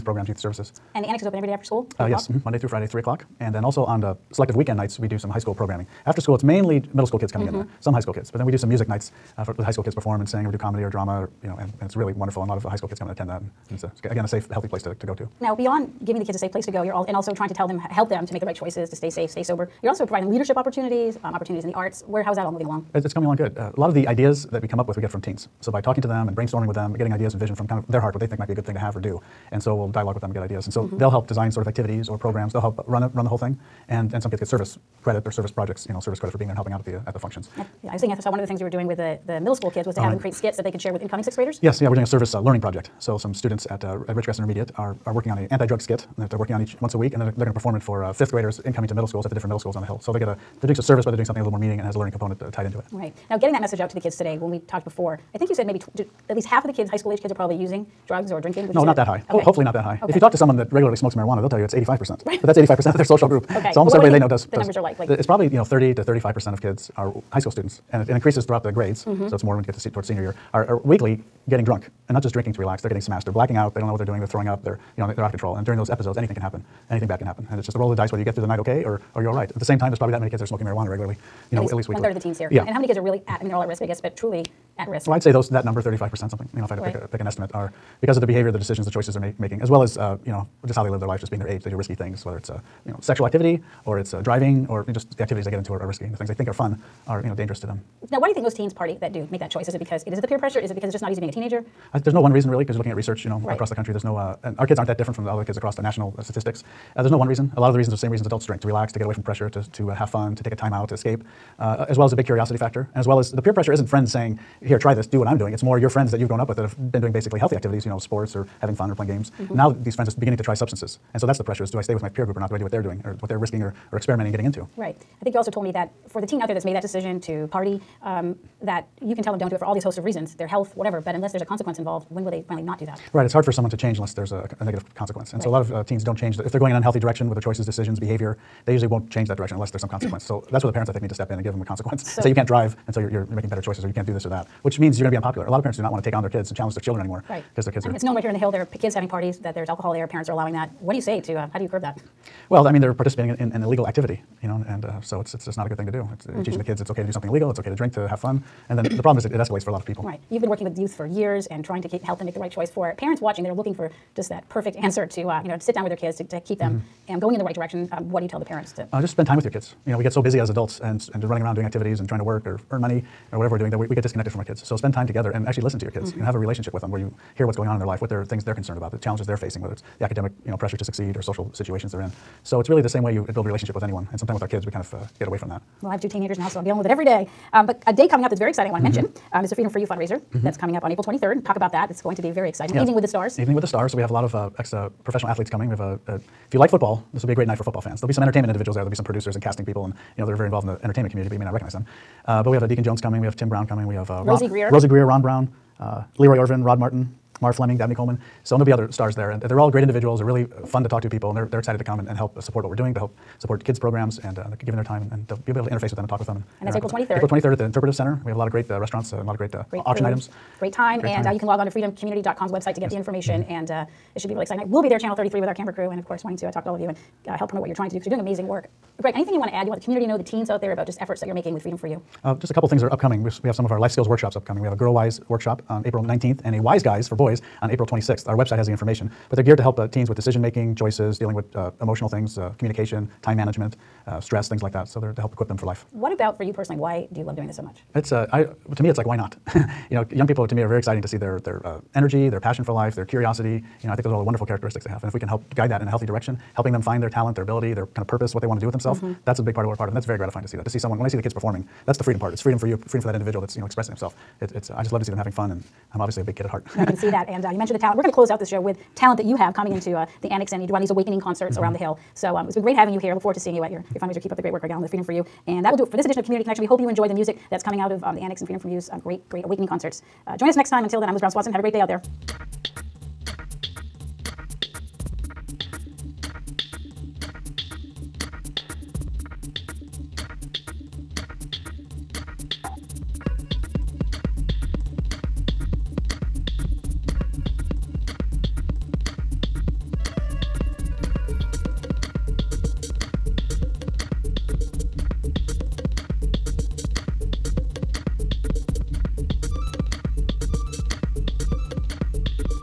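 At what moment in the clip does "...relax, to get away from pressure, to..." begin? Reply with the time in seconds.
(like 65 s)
108 s.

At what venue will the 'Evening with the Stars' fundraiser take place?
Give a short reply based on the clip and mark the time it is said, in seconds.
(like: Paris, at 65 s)
the Interpretive Center, at 217 s.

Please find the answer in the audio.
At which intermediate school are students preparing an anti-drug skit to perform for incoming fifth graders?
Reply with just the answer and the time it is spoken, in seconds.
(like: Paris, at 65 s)
Ridgecrest Intermediate, at 44 s.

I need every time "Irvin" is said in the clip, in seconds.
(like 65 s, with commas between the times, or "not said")
206 s.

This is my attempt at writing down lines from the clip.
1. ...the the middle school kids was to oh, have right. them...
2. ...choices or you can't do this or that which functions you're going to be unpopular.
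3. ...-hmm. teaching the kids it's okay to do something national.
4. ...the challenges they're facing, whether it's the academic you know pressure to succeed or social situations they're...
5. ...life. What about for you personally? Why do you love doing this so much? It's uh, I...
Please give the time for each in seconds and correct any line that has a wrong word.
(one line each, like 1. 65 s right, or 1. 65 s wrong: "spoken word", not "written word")
1. 38 s right
2. 143 s wrong: "means", not "functions"
3. 156 s wrong: "illegal", not "national"
4. 178 s right
5. 245 s right.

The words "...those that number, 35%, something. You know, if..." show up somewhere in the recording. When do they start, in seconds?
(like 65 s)
85 s.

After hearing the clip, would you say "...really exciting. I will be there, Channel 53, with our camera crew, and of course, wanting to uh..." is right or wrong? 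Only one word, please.
wrong.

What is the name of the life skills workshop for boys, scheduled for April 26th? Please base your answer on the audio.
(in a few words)
Wise Guys.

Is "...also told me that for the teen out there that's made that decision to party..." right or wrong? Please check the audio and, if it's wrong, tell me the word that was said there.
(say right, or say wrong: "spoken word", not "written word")
right.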